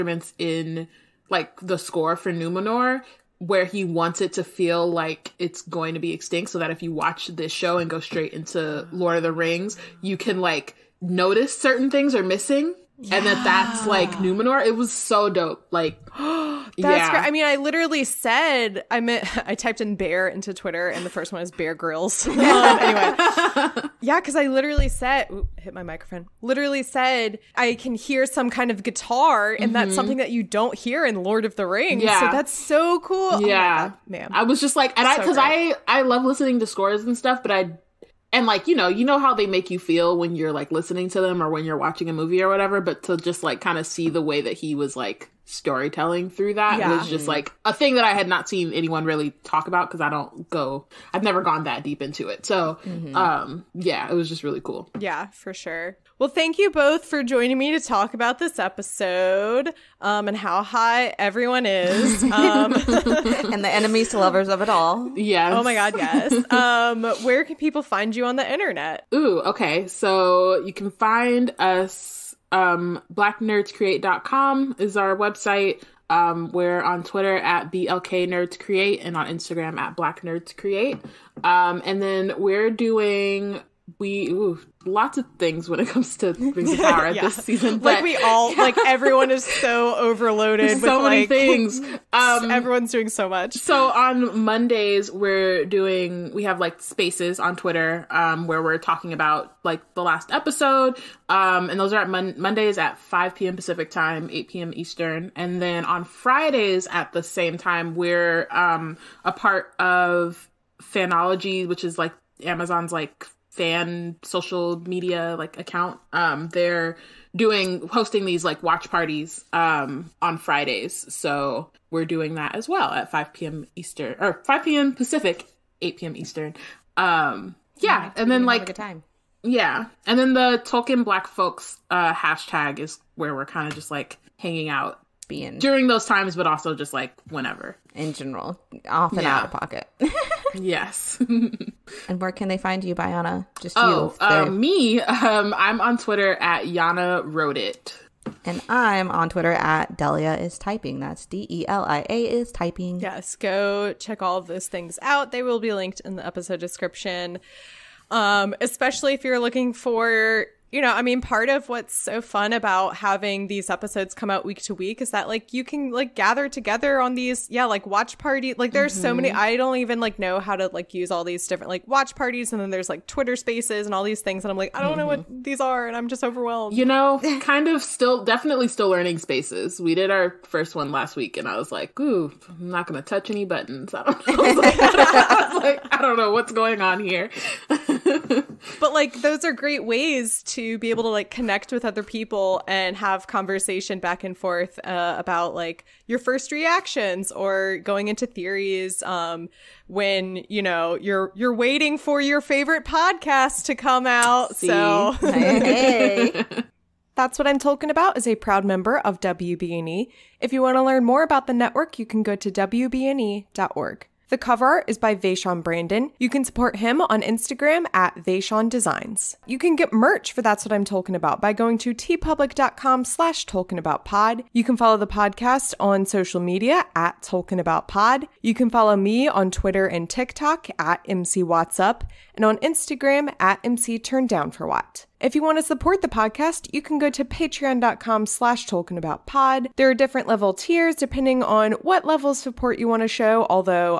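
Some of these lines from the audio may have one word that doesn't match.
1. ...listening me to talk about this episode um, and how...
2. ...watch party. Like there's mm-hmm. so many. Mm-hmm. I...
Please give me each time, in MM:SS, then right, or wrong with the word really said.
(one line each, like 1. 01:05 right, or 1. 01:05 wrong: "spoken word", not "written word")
1. 00:57 wrong: "joining", not "listening"
2. 02:47 right.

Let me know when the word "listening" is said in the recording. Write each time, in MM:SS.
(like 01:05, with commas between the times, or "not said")
00:36, 00:40.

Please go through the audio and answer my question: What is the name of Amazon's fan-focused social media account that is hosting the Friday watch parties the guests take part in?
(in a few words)
Fanology.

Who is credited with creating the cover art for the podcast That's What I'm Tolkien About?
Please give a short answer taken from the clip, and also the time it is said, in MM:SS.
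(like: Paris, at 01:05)
Vashaun Brandon, at 03:35.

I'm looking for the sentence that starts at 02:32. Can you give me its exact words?
Yes, go check all of those things out.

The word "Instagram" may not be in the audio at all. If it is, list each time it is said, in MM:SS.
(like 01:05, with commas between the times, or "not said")
01:19, 03:37, 03:52.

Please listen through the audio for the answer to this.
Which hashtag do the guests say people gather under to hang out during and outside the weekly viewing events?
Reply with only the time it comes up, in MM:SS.
02:10.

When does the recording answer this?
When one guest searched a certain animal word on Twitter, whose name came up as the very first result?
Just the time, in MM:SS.
00:21.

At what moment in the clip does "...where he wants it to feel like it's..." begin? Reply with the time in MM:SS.
00:03.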